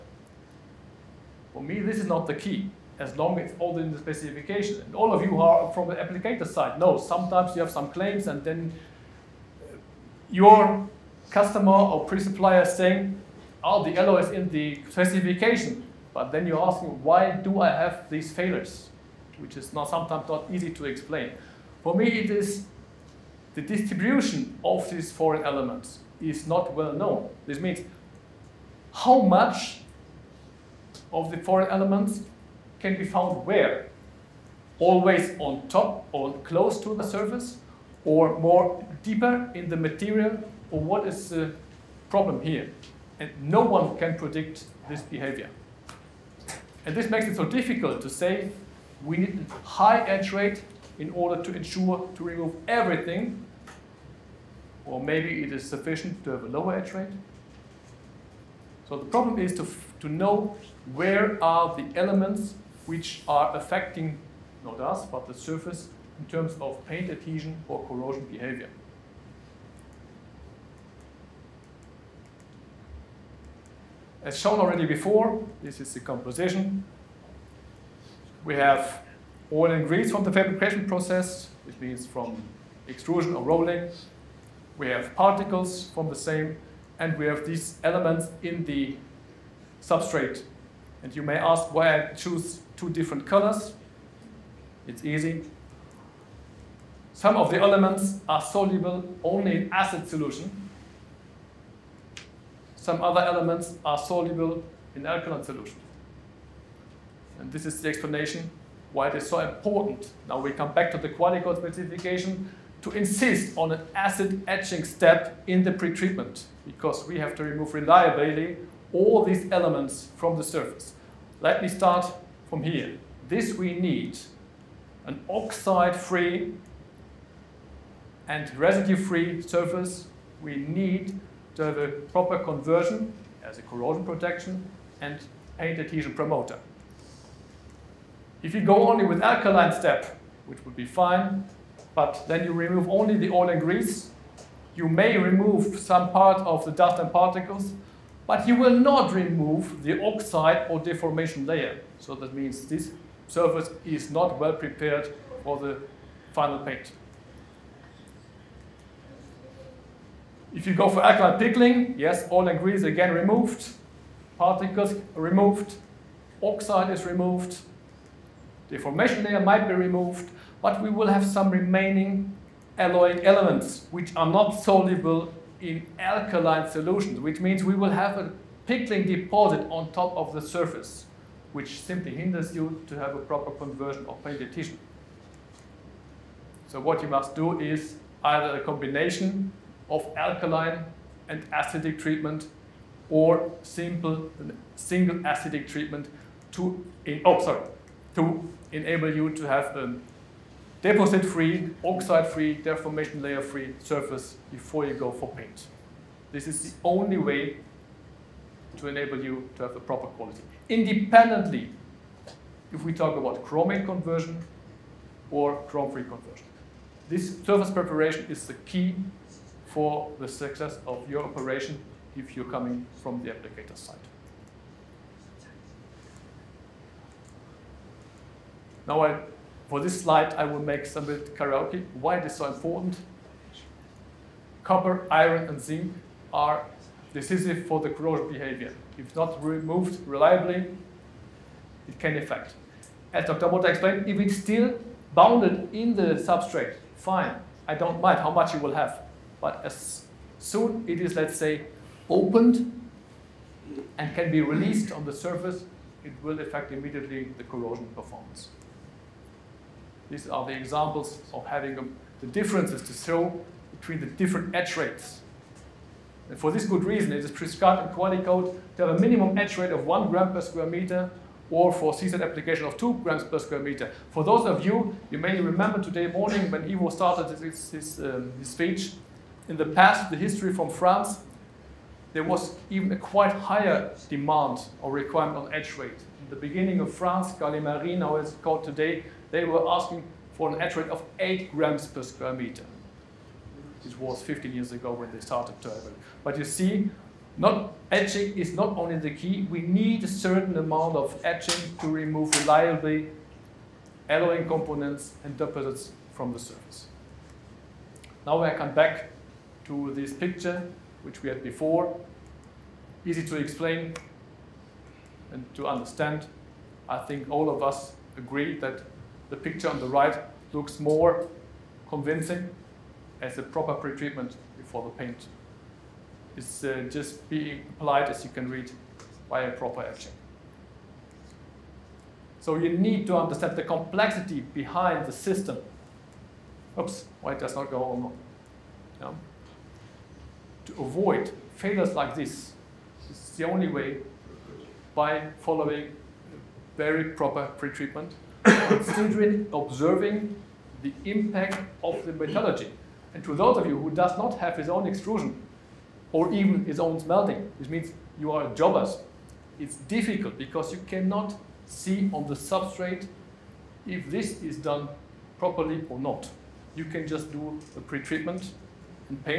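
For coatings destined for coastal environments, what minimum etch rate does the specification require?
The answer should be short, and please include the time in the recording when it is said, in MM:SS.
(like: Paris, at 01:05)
2 grams per square meter, at 04:32.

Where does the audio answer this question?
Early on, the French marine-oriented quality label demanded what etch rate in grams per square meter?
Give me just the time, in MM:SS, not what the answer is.
04:51.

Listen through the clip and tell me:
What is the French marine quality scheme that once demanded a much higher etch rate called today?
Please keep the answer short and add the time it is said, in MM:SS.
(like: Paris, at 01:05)
Qualimarine, at 04:47.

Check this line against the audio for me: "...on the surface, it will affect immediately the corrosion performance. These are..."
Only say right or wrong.
right.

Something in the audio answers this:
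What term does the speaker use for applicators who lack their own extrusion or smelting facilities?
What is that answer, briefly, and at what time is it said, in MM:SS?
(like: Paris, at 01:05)
jobbers, at 05:58.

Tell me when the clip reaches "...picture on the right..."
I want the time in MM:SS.
05:19.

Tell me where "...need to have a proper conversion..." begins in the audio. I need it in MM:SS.
02:10.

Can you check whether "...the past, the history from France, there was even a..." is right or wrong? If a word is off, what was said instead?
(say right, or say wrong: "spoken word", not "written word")
right.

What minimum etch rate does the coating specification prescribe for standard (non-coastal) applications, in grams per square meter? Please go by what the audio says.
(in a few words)
1 gram per square meter.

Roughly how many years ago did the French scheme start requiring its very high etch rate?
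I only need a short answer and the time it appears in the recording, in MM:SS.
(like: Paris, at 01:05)
15, at 04:54.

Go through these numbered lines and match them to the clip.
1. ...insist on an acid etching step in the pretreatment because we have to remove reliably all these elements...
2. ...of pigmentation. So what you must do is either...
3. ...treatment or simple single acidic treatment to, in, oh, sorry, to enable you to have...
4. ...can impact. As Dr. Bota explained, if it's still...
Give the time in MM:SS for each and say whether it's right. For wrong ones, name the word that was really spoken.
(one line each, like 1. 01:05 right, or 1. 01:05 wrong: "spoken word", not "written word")
1. 01:52 right
2. 03:04 right
3. 03:11 right
4. 04:01 wrong: "affect", not "impact".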